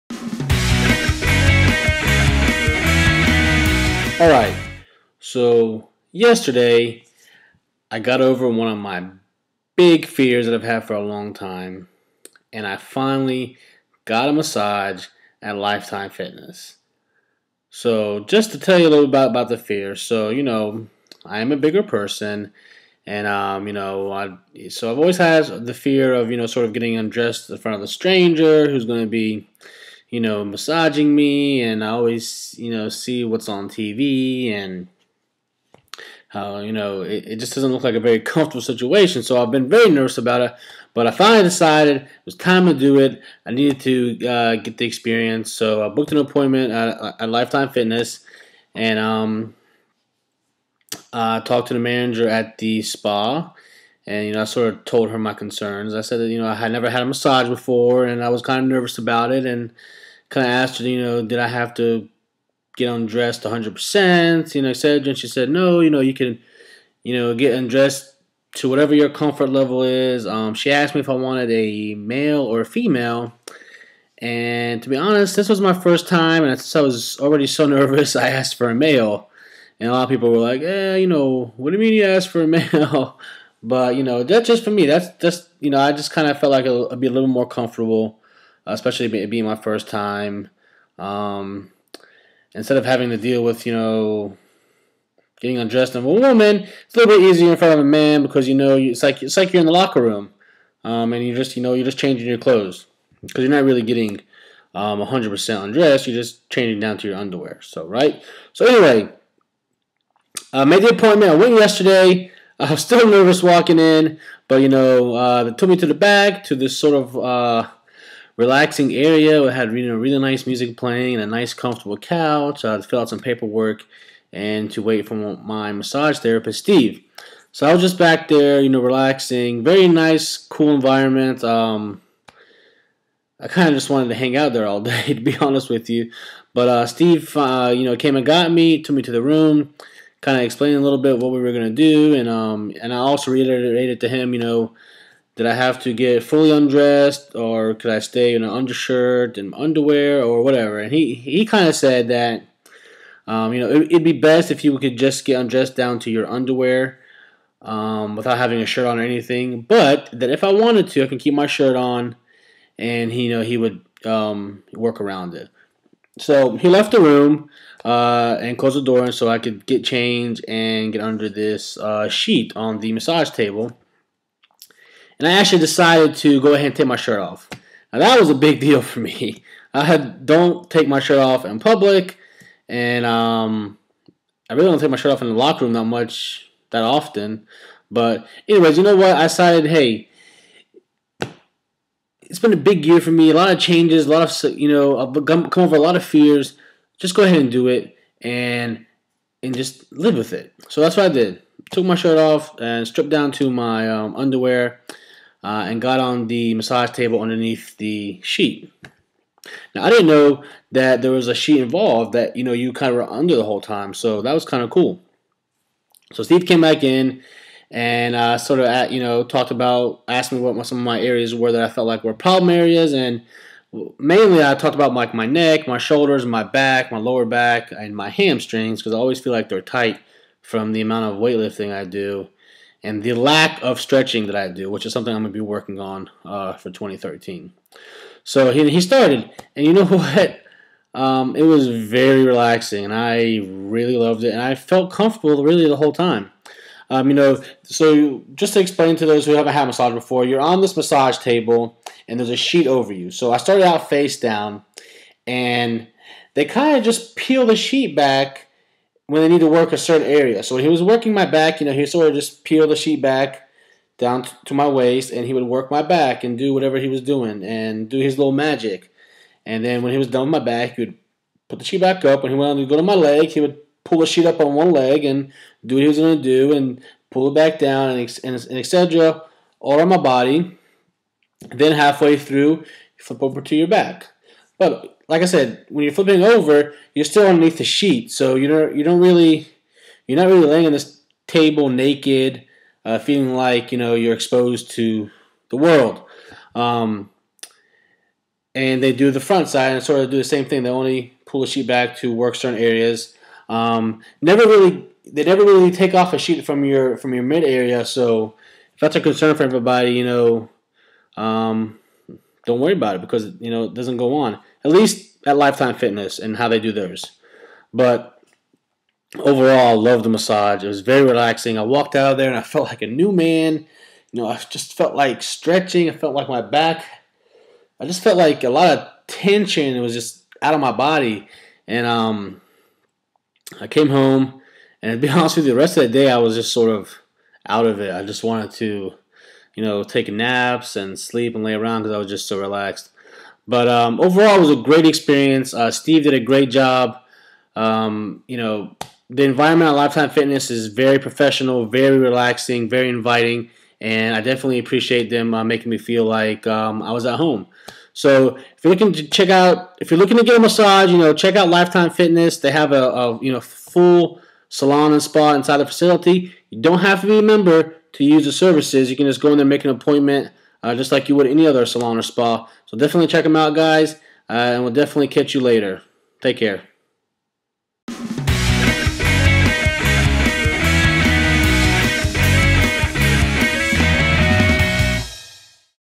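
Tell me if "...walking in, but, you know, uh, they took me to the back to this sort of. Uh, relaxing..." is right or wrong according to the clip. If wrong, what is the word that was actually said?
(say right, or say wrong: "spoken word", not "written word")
right.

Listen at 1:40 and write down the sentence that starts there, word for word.
Um, and you just, you know, you're just changing your clothes because you're not really getting um, 100% undressed.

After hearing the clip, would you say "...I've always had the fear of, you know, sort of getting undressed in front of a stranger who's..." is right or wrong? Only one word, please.
right.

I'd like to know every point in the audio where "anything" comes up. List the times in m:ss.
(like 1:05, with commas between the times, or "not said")
2:39.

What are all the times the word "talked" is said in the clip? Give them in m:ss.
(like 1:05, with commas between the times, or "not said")
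0:51, 3:39, 3:44.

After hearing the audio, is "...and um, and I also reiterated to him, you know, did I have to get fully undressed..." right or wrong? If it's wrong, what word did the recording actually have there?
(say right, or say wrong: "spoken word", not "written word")
right.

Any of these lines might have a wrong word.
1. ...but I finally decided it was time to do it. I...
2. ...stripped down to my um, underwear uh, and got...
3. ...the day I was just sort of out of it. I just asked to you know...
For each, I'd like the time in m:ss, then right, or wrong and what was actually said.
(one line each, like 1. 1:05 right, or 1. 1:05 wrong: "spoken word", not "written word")
1. 0:40 right
2. 3:22 right
3. 5:35 wrong: "wanted", not "asked".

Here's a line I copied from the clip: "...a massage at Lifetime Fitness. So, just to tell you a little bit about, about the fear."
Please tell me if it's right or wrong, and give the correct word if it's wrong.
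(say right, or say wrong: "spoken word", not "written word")
right.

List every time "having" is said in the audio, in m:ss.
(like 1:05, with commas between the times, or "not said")
1:32, 2:38.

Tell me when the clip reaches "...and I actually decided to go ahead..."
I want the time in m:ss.
2:55.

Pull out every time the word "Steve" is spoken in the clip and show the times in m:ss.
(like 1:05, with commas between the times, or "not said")
2:06, 2:16, 3:36, 5:45.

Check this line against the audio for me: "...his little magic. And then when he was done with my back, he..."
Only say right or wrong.
right.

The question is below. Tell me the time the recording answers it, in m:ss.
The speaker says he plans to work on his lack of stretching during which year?
3:56.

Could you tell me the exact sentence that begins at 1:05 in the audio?
And she said, no, you know, you can, you know, get undressed to whatever your comfort level is.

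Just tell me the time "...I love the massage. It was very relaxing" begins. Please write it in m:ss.
5:19.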